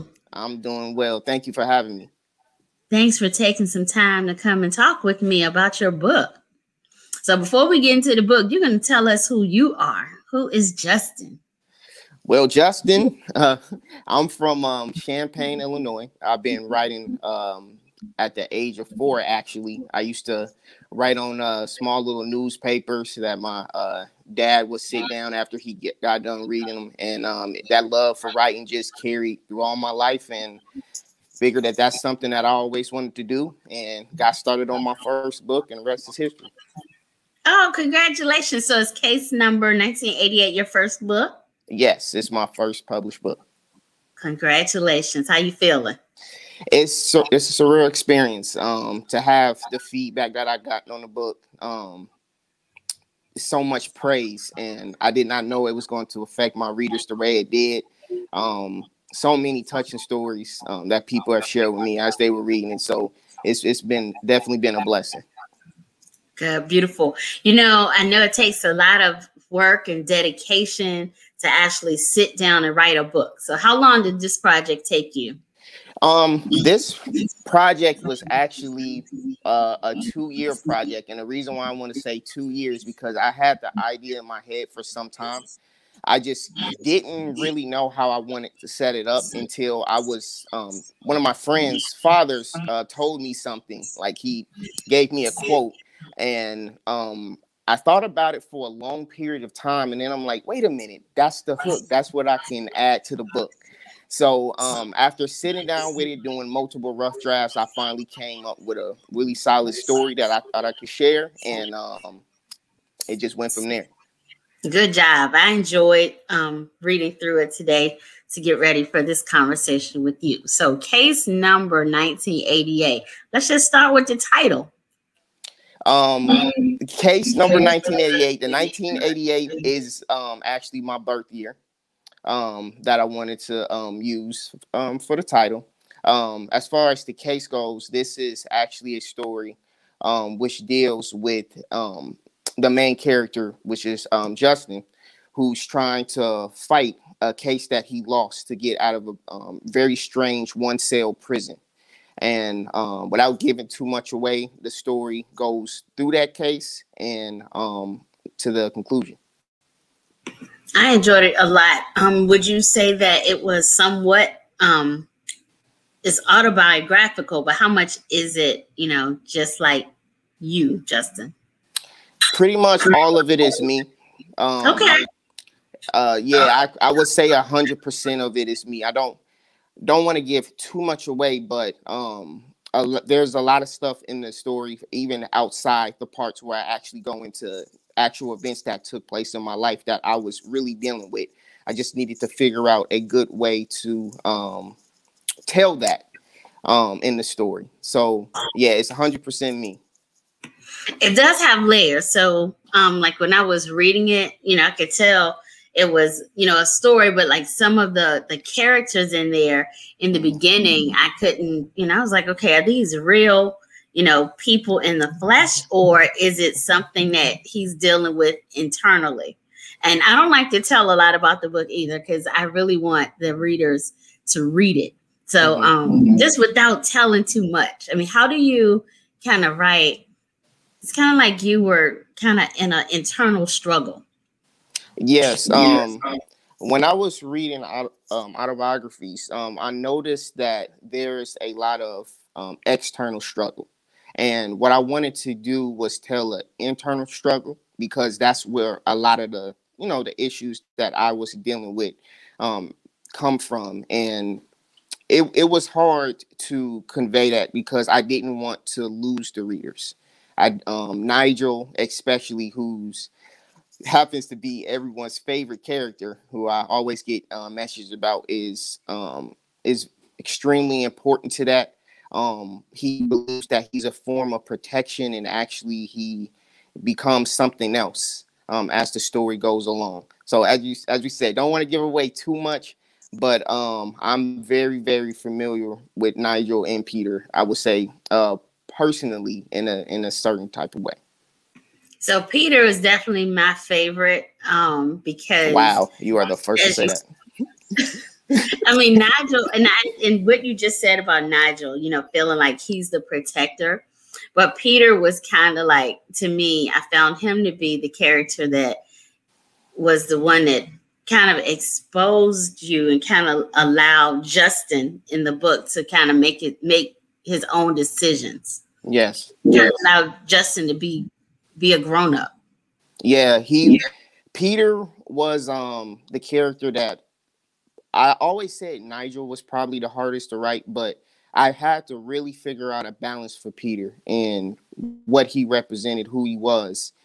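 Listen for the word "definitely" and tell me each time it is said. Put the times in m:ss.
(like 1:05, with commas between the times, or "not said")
1:04, 4:52.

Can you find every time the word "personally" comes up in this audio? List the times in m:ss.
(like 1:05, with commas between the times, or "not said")
4:48.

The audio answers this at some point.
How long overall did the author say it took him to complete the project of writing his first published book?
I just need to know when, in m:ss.
1:20.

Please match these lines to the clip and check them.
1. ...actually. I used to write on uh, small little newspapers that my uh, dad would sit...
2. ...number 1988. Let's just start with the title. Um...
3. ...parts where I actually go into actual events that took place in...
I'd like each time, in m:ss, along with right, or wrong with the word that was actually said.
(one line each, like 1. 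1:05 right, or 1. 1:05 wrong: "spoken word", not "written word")
1. 0:19 right
2. 2:01 right
3. 3:06 right.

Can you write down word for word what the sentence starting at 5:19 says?
Now Justin to be be a grown up.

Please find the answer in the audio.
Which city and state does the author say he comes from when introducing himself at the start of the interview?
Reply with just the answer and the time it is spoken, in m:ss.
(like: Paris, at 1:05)
Champaign, Illinois, at 0:14.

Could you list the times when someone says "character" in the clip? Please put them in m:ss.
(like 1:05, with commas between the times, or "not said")
2:22, 3:28, 4:25, 5:07, 5:26.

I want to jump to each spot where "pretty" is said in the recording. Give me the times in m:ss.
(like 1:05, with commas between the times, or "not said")
2:52.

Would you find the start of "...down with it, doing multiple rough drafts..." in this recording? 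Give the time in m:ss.
1:45.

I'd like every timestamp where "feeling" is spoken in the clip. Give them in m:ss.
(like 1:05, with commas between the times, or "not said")
0:45, 5:02.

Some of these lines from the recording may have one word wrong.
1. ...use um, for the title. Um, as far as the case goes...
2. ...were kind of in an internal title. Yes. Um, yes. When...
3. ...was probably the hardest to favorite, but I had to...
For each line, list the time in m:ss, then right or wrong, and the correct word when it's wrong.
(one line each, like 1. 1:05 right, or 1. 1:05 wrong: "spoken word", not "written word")
1. 2:14 right
2. 3:51 wrong: "struggle", not "title"
3. 5:29 wrong: "write", not "favorite".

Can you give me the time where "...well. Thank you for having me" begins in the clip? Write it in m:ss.
0:00.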